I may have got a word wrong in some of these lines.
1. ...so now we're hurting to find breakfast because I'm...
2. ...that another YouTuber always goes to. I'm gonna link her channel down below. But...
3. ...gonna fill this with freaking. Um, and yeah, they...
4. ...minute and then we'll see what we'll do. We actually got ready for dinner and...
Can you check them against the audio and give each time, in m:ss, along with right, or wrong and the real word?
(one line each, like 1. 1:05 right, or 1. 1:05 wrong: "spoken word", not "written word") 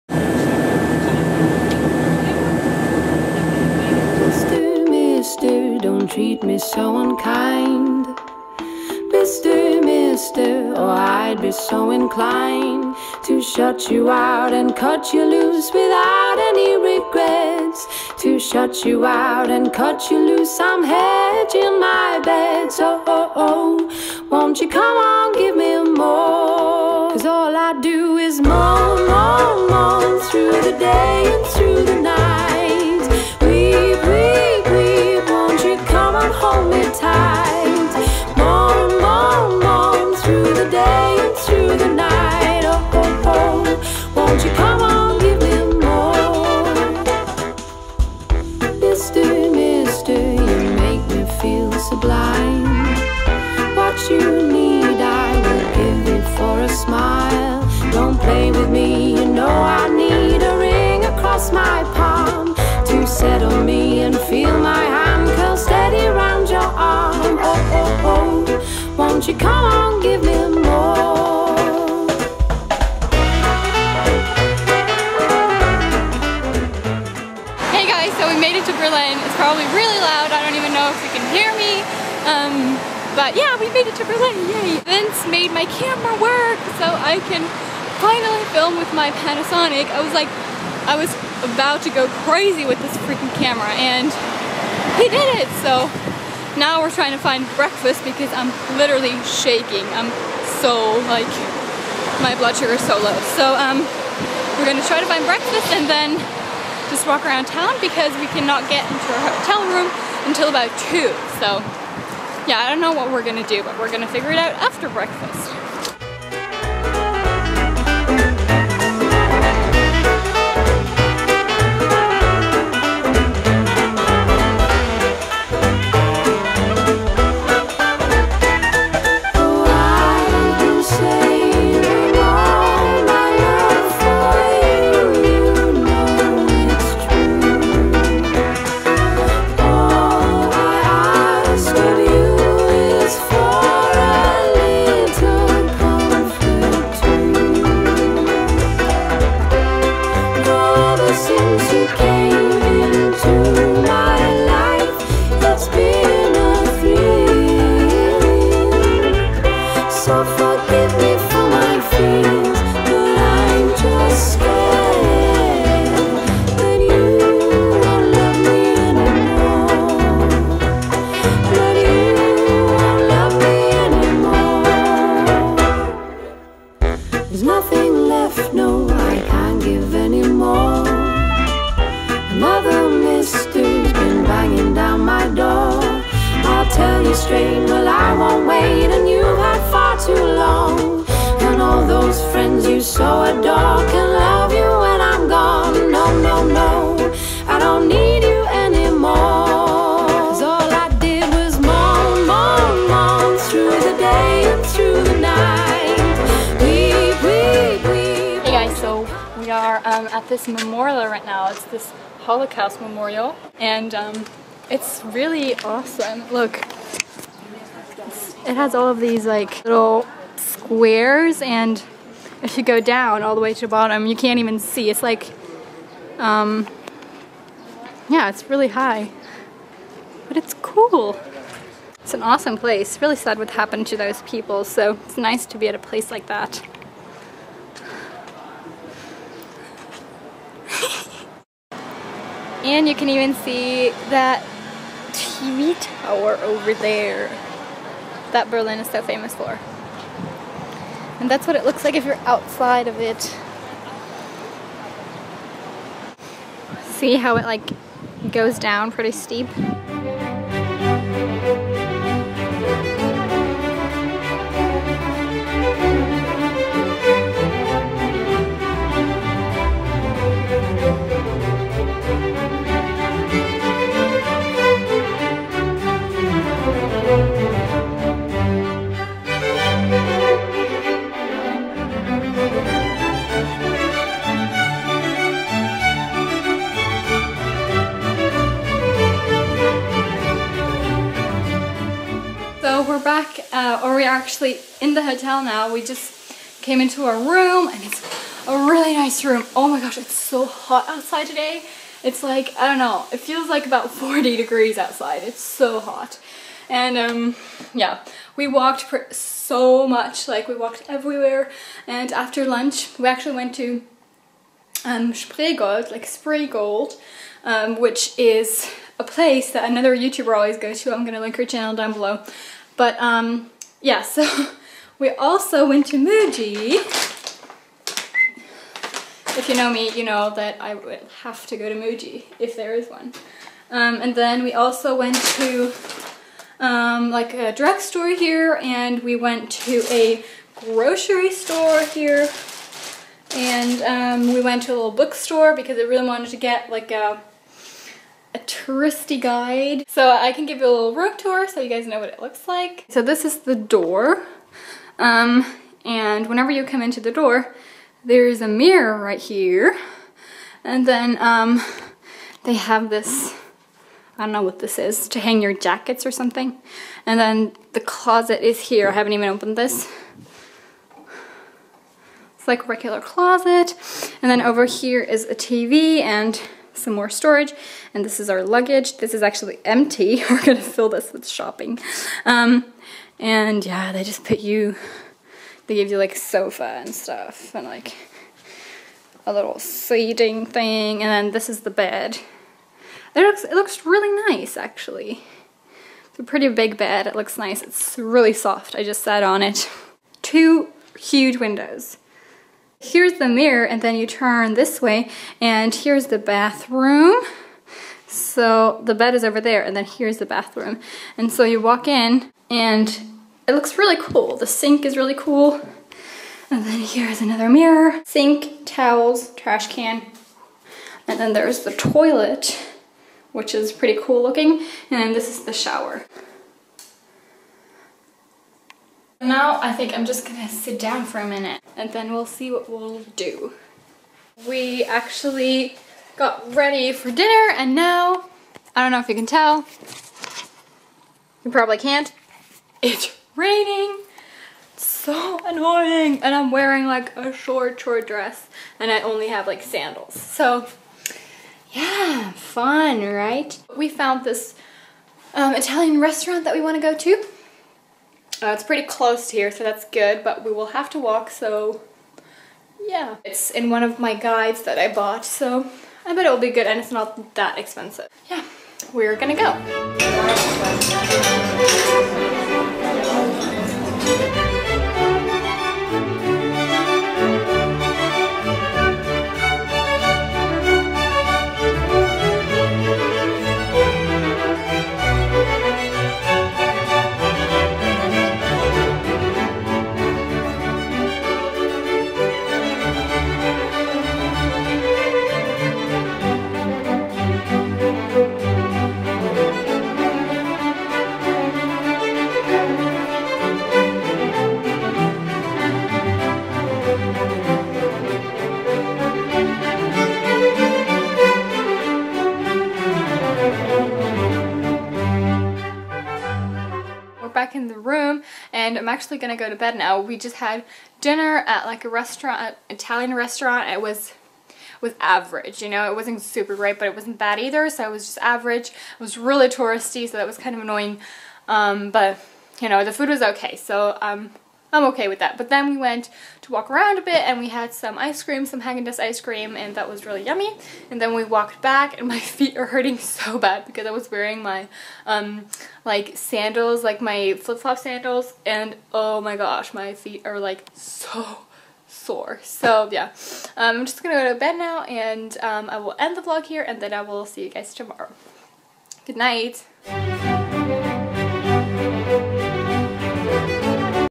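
1. 1:35 wrong: "trying", not "hurting"
2. 5:19 right
3. 6:20 wrong: "shopping", not "freaking"
4. 7:11 right.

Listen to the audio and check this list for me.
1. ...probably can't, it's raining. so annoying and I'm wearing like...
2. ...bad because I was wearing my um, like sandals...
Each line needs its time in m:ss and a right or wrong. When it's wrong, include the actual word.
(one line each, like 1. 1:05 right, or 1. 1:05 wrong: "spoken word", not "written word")
1. 7:21 right
2. 9:03 right.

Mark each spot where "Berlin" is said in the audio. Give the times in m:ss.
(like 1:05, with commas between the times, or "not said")
1:18, 1:24, 4:08.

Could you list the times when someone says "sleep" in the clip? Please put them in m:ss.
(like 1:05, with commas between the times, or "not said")
not said.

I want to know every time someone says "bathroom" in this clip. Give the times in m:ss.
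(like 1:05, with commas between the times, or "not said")
6:46, 6:50.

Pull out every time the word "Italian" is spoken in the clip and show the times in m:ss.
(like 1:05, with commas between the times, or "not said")
7:35, 8:42.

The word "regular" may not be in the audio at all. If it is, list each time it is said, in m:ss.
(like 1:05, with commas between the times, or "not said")
6:12.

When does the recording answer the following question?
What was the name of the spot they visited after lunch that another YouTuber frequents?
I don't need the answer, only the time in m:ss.
5:15.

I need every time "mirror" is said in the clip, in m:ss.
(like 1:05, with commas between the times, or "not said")
5:58, 6:43, 6:57.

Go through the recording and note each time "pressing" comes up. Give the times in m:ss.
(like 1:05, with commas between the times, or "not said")
not said.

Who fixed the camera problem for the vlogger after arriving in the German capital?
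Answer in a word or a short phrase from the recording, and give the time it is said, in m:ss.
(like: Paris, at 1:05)
Vince, at 1:24.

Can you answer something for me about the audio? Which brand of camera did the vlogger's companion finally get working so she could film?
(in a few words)
Panasonic.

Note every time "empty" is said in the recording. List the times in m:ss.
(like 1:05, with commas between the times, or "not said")
6:19.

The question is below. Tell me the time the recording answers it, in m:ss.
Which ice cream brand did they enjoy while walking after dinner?
8:58.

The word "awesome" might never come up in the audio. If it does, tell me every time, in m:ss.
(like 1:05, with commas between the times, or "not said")
3:35, 3:52.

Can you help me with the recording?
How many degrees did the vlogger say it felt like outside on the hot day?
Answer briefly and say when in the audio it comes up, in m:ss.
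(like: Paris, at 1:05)
40, at 5:03.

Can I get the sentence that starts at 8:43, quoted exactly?
It was was average, you know, it wasn't super great, but it wasn't bad either, so it was just average.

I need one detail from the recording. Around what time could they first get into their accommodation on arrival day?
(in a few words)
2.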